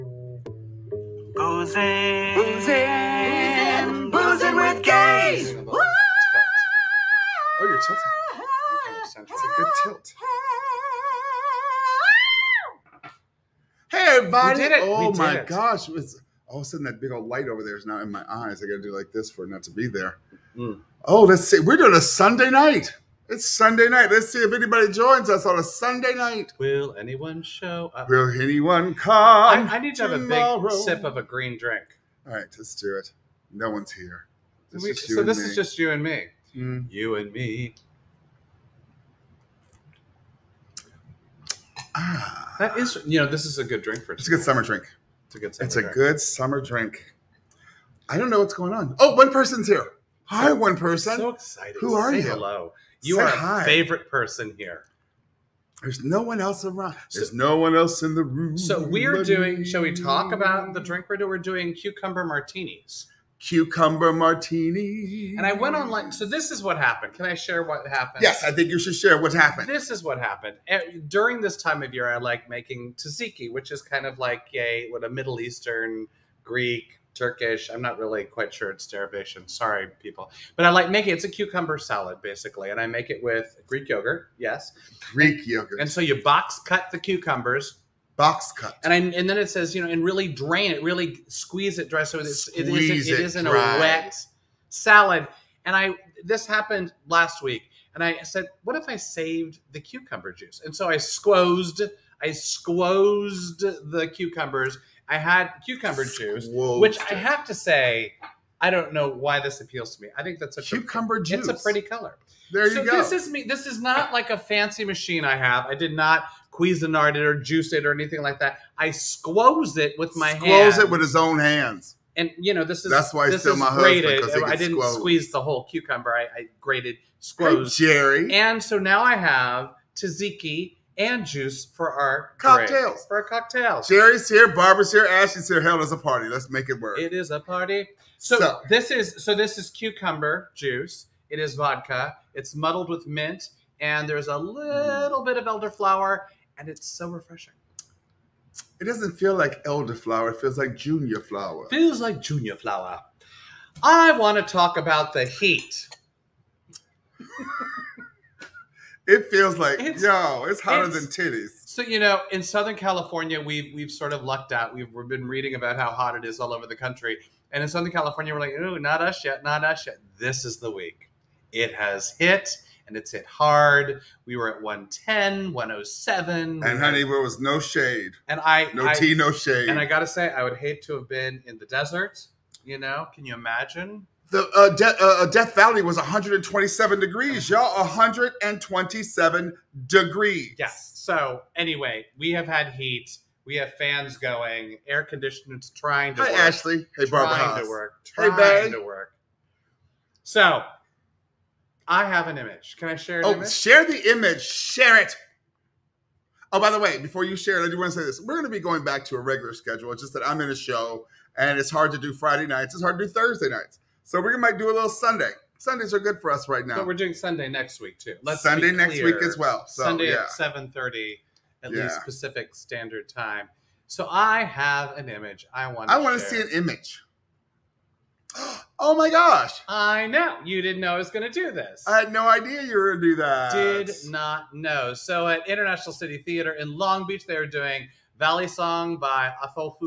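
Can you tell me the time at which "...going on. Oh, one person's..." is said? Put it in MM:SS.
00:48.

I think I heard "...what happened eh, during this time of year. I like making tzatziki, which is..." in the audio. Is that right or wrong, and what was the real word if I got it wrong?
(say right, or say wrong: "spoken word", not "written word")
right.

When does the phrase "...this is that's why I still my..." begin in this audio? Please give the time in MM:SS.
02:02.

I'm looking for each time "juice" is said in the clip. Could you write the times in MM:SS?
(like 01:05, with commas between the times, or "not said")
01:40, 01:46, 01:51, 01:57, 02:11, 02:20.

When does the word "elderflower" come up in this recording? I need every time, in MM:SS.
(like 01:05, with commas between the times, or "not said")
02:25, 02:29.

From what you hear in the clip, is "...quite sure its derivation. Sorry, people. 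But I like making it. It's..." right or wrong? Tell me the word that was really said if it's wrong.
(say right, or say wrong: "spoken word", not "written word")
right.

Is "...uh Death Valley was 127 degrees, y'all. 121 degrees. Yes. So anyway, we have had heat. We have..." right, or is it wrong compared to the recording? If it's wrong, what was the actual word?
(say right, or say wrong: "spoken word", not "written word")
wrong: "127", not "121".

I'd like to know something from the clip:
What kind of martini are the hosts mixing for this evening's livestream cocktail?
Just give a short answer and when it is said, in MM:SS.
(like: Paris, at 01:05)
Cucumber martini, at 01:03.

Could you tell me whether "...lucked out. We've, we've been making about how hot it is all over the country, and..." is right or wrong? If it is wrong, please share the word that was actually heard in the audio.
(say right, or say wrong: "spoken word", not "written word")
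wrong: "reading", not "making".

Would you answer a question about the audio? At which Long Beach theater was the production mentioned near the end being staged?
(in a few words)
International City Theater.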